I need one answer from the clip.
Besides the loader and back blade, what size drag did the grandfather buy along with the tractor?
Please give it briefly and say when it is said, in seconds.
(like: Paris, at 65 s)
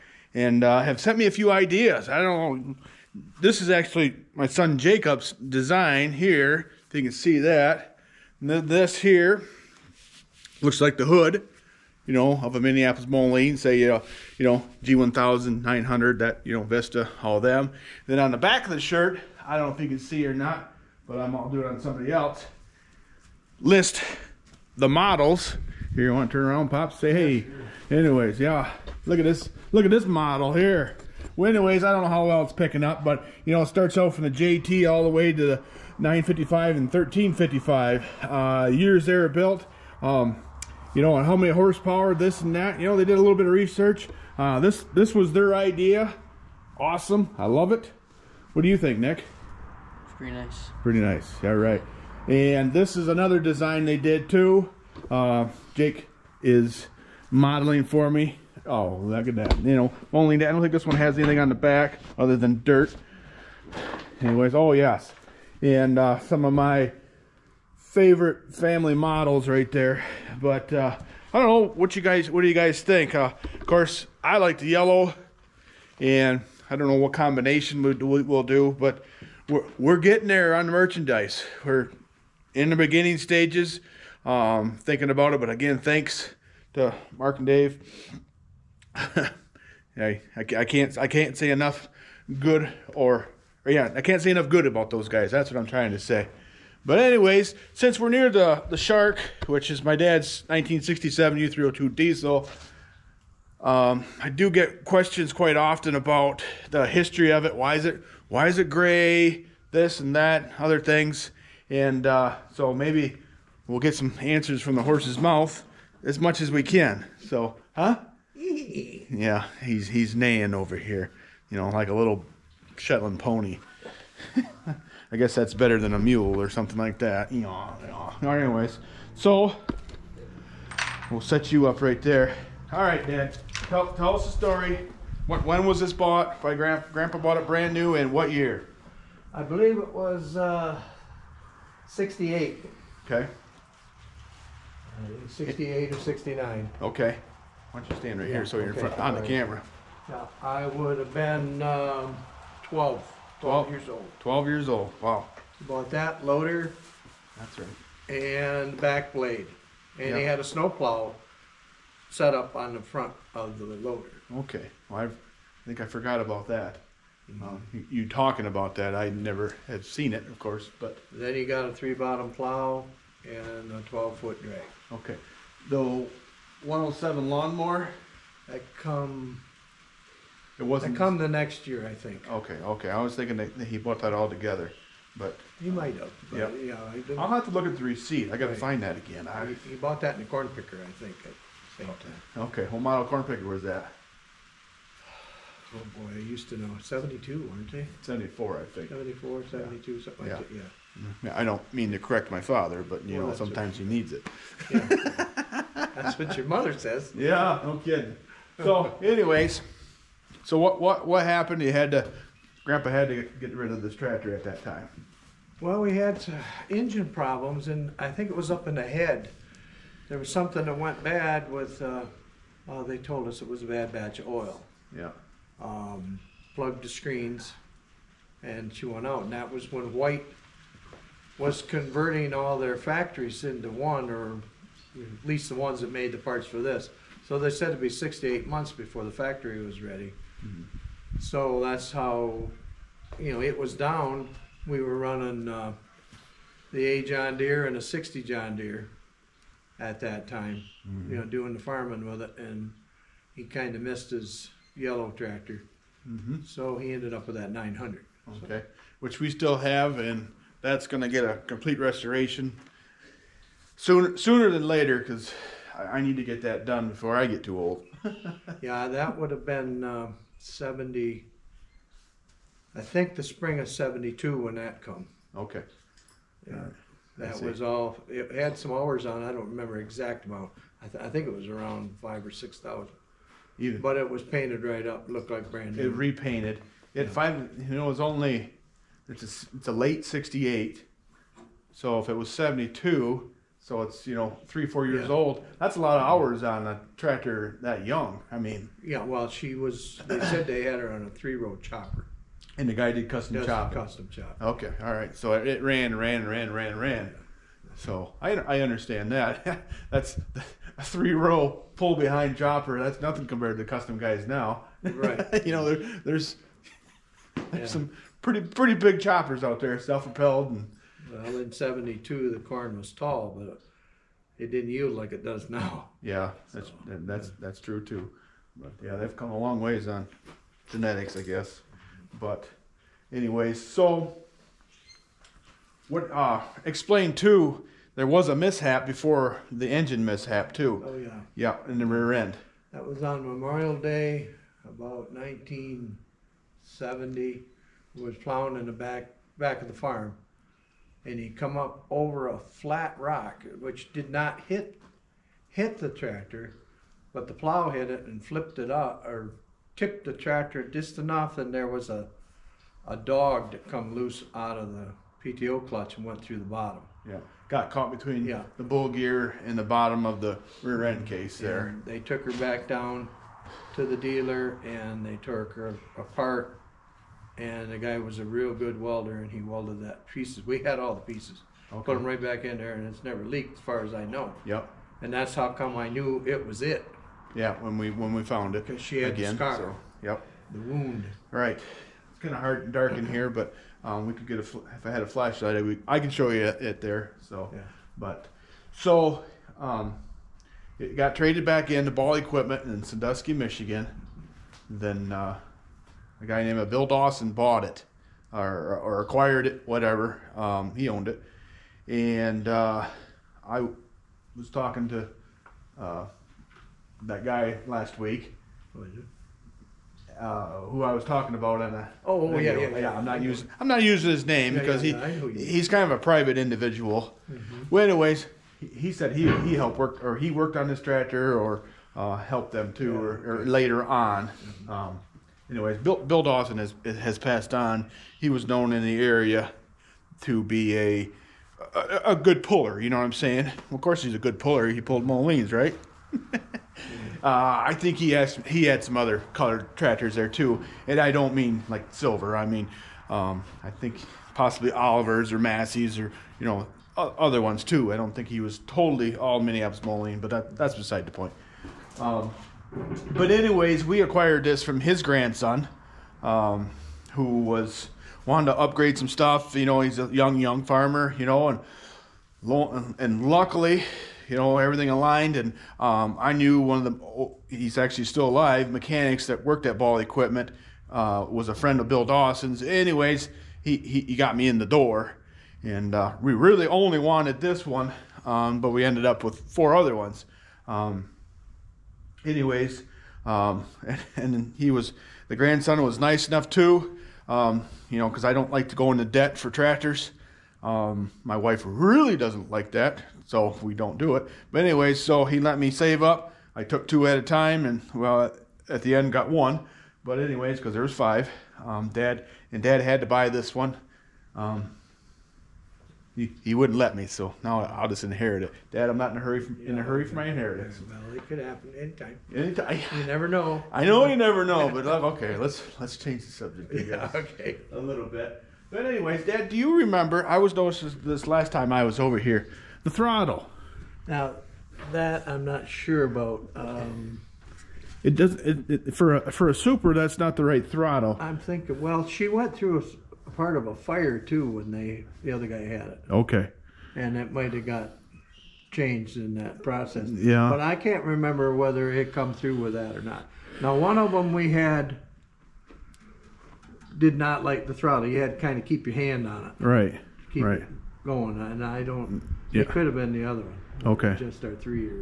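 12 foot, at 173 s.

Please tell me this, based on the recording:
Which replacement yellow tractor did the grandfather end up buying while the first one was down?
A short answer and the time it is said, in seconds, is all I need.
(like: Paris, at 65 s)
900, at 257 s.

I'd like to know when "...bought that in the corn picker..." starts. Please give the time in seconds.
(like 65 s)
189 s.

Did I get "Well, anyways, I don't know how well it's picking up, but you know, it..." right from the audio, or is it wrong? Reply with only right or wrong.
right.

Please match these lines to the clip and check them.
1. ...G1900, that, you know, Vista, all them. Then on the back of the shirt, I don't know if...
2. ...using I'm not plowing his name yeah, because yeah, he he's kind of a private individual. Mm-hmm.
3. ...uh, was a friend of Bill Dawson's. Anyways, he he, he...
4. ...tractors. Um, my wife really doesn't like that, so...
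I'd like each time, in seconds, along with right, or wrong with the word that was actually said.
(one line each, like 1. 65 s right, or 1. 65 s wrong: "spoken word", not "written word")
1. 14 s right
2. 423 s wrong: "using", not "plowing"
3. 480 s right
4. 499 s right.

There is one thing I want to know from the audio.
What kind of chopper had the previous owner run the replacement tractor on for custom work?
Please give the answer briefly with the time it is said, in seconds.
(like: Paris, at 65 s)
three-row chopper, at 301 s.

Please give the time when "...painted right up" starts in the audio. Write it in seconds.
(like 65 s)
284 s.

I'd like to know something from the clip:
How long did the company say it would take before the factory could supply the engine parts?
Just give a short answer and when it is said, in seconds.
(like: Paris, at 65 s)
6 to 8 months, at 237 s.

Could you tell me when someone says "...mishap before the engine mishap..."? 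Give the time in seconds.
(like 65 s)
338 s.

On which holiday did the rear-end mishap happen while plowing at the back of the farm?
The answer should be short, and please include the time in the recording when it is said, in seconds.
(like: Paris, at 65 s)
Memorial Day, at 343 s.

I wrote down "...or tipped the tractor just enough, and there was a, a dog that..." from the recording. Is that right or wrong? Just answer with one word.
right.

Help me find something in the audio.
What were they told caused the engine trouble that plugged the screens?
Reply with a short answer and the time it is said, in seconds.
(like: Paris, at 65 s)
A bad batch of oil, at 223 s.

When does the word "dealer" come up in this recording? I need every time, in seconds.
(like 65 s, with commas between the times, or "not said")
373 s.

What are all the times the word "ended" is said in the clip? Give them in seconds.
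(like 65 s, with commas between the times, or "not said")
256 s, 488 s.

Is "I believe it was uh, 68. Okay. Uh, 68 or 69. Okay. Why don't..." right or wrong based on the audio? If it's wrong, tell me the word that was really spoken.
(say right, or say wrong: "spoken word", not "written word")
right.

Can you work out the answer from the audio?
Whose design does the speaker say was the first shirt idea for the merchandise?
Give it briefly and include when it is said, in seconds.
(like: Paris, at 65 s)
Jacob, at 4 s.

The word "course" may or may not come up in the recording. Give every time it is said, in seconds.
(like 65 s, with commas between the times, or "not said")
73 s, 170 s, 443 s.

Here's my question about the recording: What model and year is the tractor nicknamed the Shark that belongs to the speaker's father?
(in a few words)
1967 U302 diesel.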